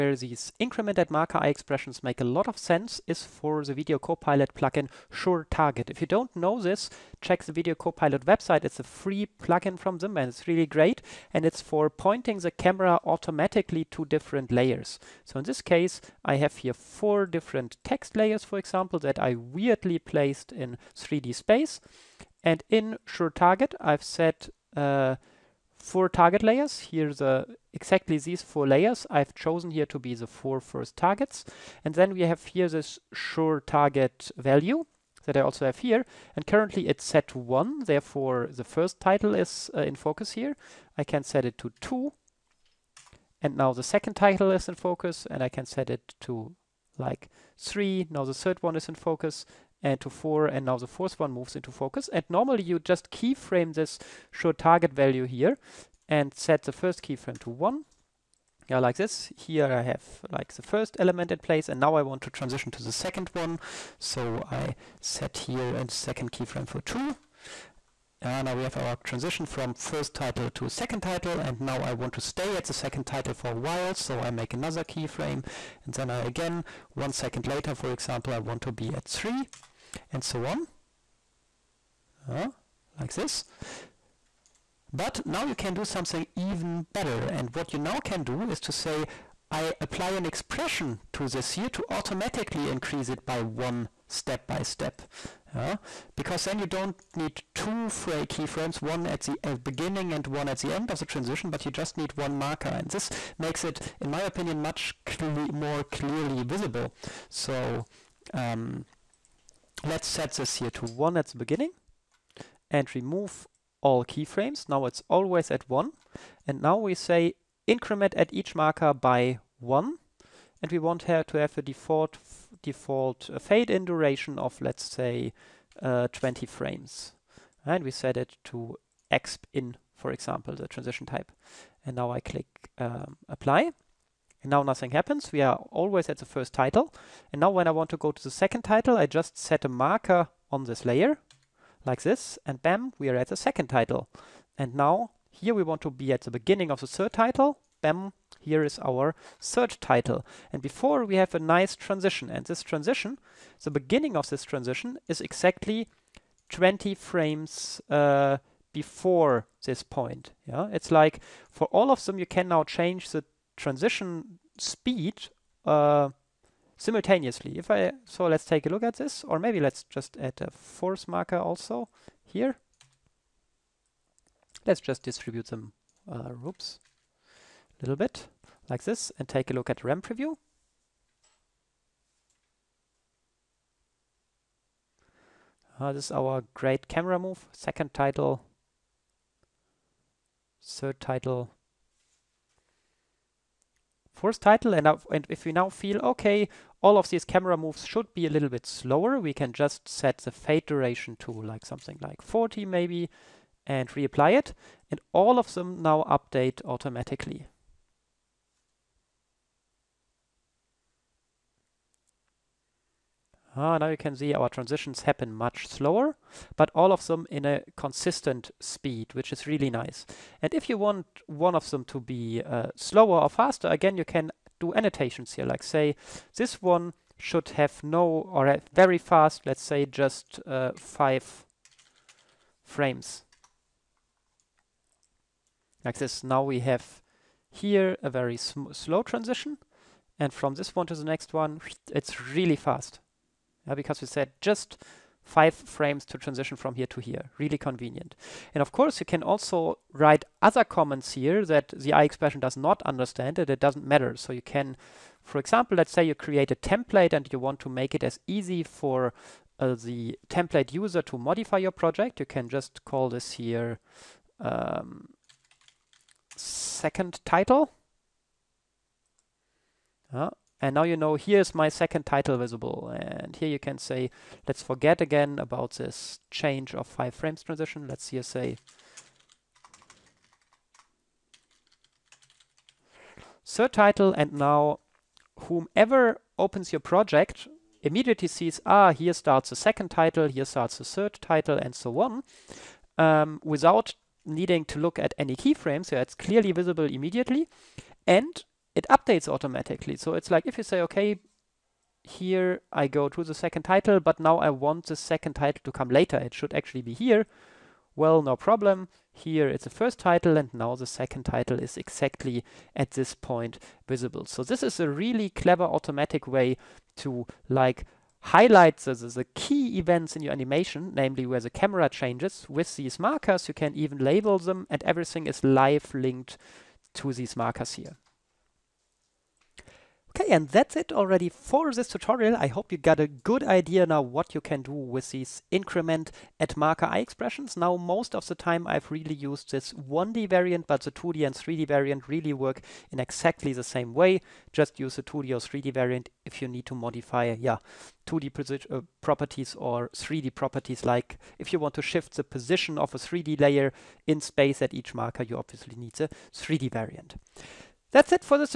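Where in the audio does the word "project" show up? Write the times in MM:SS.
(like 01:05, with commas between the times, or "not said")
04:21, 04:46.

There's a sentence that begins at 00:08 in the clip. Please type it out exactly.
It's a free plugin from them and it's really great.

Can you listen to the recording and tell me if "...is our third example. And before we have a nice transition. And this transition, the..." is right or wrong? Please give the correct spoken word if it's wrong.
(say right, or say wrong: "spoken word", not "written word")
wrong: "title", not "example".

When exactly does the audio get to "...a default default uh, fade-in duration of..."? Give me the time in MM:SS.
02:01.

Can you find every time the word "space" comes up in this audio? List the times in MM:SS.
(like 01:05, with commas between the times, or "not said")
00:21, 05:54.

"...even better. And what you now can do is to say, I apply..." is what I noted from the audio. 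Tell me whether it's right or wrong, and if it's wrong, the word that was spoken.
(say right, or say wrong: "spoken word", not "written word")
right.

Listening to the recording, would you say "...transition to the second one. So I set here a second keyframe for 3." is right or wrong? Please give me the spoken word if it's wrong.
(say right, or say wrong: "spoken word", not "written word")
wrong: "2", not "3".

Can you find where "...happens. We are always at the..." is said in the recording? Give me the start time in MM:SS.
02:14.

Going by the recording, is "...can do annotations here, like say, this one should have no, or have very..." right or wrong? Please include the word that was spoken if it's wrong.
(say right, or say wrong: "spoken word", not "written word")
right.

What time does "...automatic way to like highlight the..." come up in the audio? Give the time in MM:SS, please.
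05:15.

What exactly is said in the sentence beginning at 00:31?
And then we have here this sure target value that I also have here.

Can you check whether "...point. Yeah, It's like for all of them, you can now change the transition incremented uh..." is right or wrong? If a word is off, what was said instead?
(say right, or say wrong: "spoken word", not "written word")
wrong: "speed", not "incremented".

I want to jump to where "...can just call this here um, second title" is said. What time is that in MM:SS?
04:22.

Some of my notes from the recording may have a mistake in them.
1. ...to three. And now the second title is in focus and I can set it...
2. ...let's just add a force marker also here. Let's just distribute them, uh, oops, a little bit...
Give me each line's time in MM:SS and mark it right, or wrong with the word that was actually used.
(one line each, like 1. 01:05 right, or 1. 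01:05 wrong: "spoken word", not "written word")
1. 00:41 wrong: "two", not "three"
2. 02:49 right.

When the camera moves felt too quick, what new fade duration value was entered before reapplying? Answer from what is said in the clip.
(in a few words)
40.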